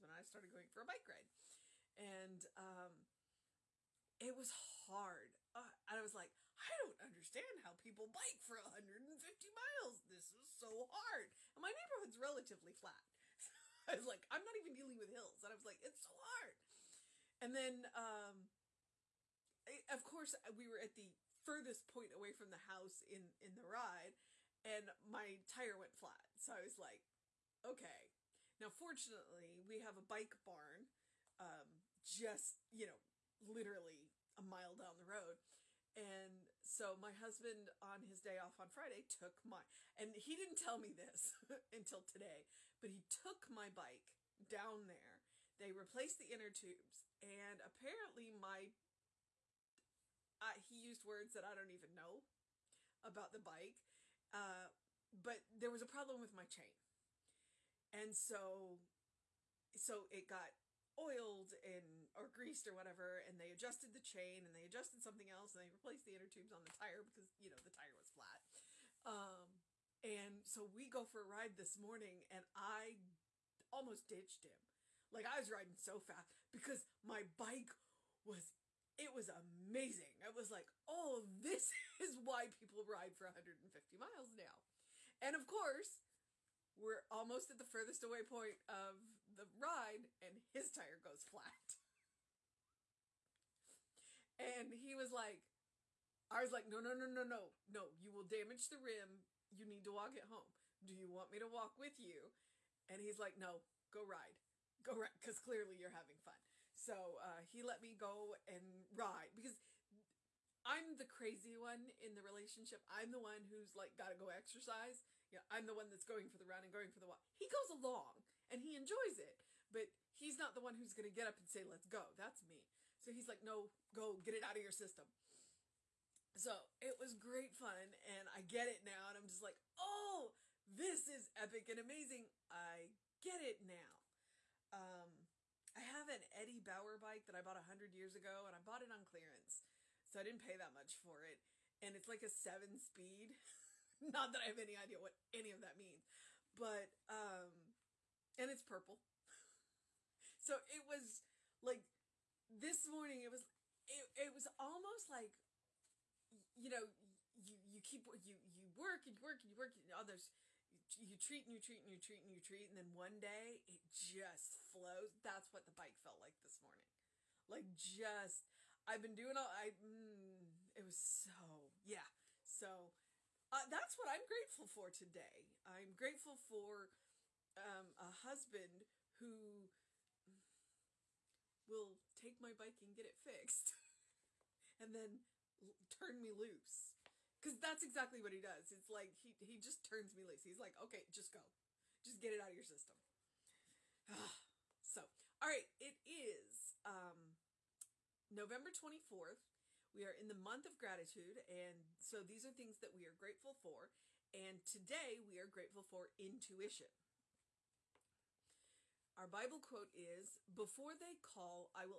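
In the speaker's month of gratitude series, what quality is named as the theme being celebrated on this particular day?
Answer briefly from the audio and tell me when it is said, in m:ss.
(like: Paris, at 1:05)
intuition, at 3:26.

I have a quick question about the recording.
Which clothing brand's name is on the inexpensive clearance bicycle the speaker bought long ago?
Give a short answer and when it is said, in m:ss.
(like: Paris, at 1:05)
Eddie Bauer, at 2:16.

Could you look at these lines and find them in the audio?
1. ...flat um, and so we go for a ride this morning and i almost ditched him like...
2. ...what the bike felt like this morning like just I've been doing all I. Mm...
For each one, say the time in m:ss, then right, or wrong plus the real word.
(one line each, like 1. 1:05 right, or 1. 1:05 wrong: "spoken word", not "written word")
1. 1:08 right
2. 2:45 right.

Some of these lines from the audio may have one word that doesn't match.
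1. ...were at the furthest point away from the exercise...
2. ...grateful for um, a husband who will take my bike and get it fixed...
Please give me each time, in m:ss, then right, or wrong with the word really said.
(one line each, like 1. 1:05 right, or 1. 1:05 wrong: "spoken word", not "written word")
1. 0:20 wrong: "house", not "exercise"
2. 2:55 right.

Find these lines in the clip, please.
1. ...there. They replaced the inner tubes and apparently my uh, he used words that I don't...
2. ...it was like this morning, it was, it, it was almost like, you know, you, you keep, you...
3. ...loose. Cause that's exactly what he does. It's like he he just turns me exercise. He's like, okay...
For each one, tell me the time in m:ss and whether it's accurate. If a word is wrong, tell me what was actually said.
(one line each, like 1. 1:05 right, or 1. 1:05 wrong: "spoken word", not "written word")
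1. 0:44 right
2. 2:30 right
3. 3:06 wrong: "loose", not "exercise".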